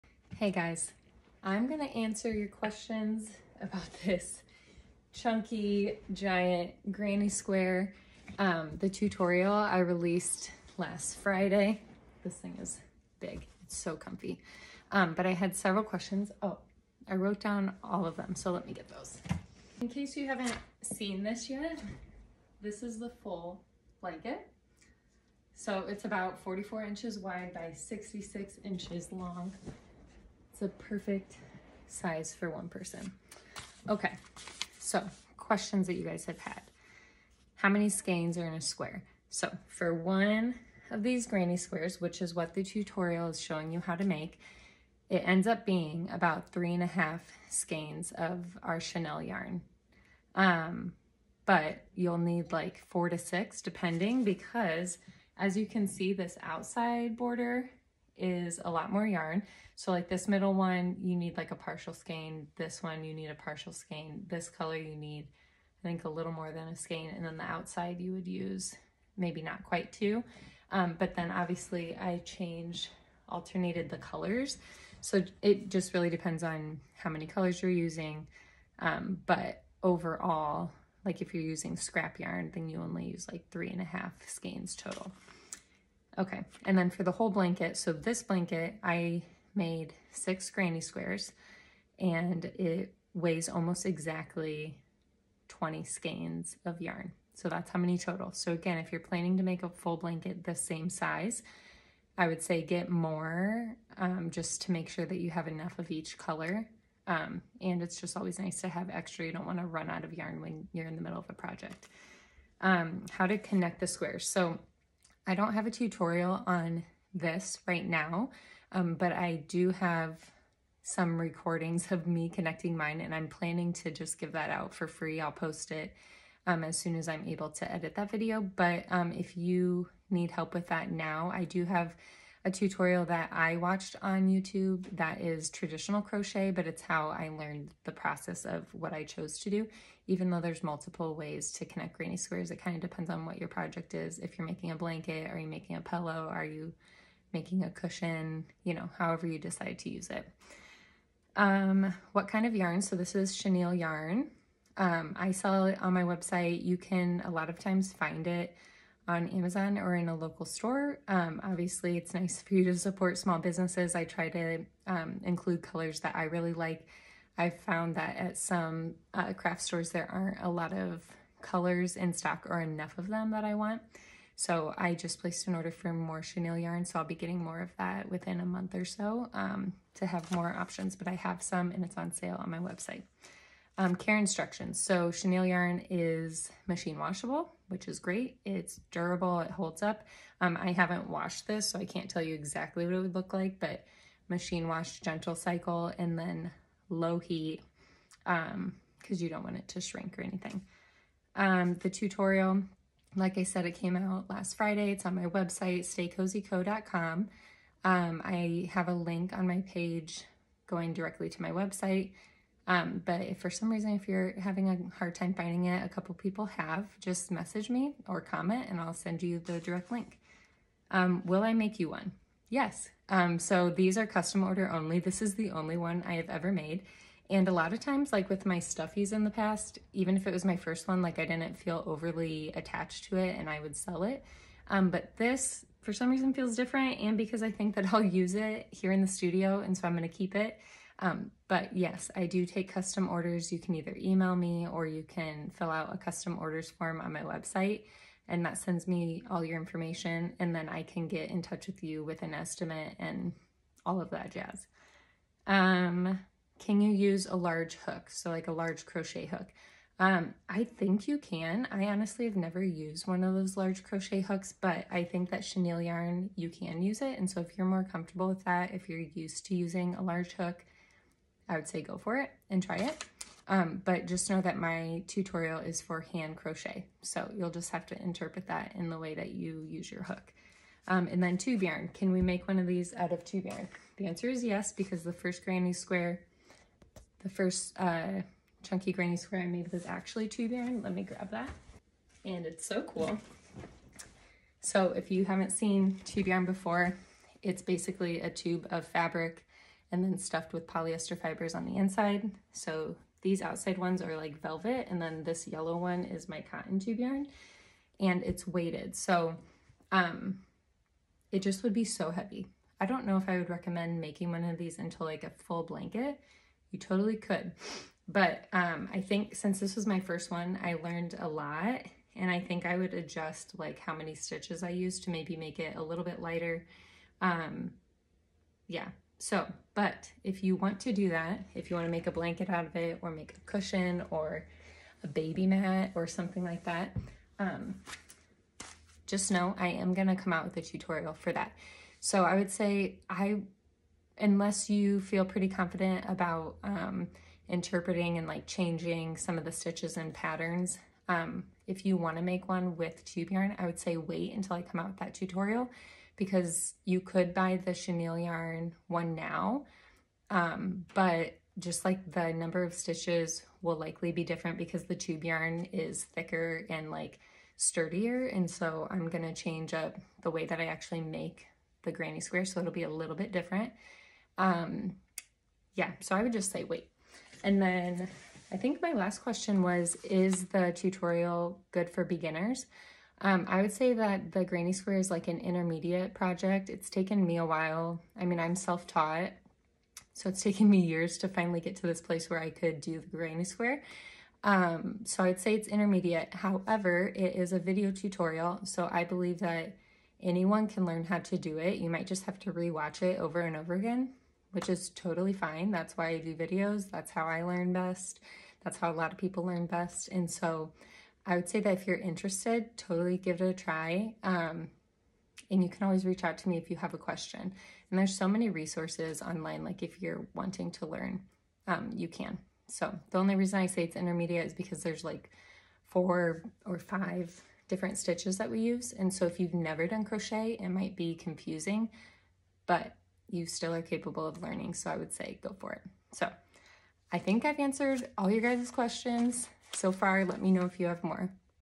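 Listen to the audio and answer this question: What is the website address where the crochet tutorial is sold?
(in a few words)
staycozyco.com.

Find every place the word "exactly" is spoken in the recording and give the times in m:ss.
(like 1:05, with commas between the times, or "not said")
1:33, 3:12.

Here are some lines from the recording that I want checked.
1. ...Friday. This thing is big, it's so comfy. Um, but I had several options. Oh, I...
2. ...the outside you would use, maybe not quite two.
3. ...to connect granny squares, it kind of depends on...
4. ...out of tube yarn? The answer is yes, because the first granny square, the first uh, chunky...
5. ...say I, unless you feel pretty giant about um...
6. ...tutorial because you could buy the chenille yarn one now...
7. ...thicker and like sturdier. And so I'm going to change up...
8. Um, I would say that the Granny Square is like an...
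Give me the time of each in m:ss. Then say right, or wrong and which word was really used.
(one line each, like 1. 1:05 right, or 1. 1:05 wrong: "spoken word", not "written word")
1. 0:11 wrong: "questions", not "options"
2. 1:07 right
3. 2:21 right
4. 4:42 right
5. 5:42 wrong: "confident", not "giant"
6. 5:55 right
7. 6:06 right
8. 6:23 right.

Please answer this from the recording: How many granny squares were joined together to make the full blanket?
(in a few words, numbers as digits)
6.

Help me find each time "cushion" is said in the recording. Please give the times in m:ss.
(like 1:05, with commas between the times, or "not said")
2:27, 5:33.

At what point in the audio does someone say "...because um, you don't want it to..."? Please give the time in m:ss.
3:18.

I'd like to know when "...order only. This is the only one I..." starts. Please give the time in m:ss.
3:44.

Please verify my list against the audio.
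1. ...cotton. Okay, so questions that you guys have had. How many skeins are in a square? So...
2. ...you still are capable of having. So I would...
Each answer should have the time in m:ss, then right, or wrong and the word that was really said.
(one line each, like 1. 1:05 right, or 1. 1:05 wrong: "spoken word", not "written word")
1. 0:32 wrong: "person", not "cotton"
2. 7:13 wrong: "learning", not "having".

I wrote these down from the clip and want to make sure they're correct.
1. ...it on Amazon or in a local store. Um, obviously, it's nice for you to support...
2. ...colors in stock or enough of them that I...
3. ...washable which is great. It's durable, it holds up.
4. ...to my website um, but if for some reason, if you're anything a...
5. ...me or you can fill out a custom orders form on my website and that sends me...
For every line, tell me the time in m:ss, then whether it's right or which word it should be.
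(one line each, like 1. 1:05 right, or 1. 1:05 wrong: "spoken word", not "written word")
1. 2:38 right
2. 2:51 right
3. 3:06 right
4. 3:31 wrong: "having", not "anything"
5. 4:04 right.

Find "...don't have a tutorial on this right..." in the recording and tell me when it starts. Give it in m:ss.
1:55.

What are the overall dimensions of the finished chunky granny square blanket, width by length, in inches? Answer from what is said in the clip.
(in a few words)
44 by 66 inches.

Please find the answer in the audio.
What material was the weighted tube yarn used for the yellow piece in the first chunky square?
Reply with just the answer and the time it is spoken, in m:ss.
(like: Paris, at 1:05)
Cotton, at 5:06.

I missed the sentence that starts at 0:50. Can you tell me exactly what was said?
Um, but you'll need like four to six depending because as you can see this outside border is a lot more yarn.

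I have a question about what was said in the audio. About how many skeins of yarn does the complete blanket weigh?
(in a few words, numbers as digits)
20.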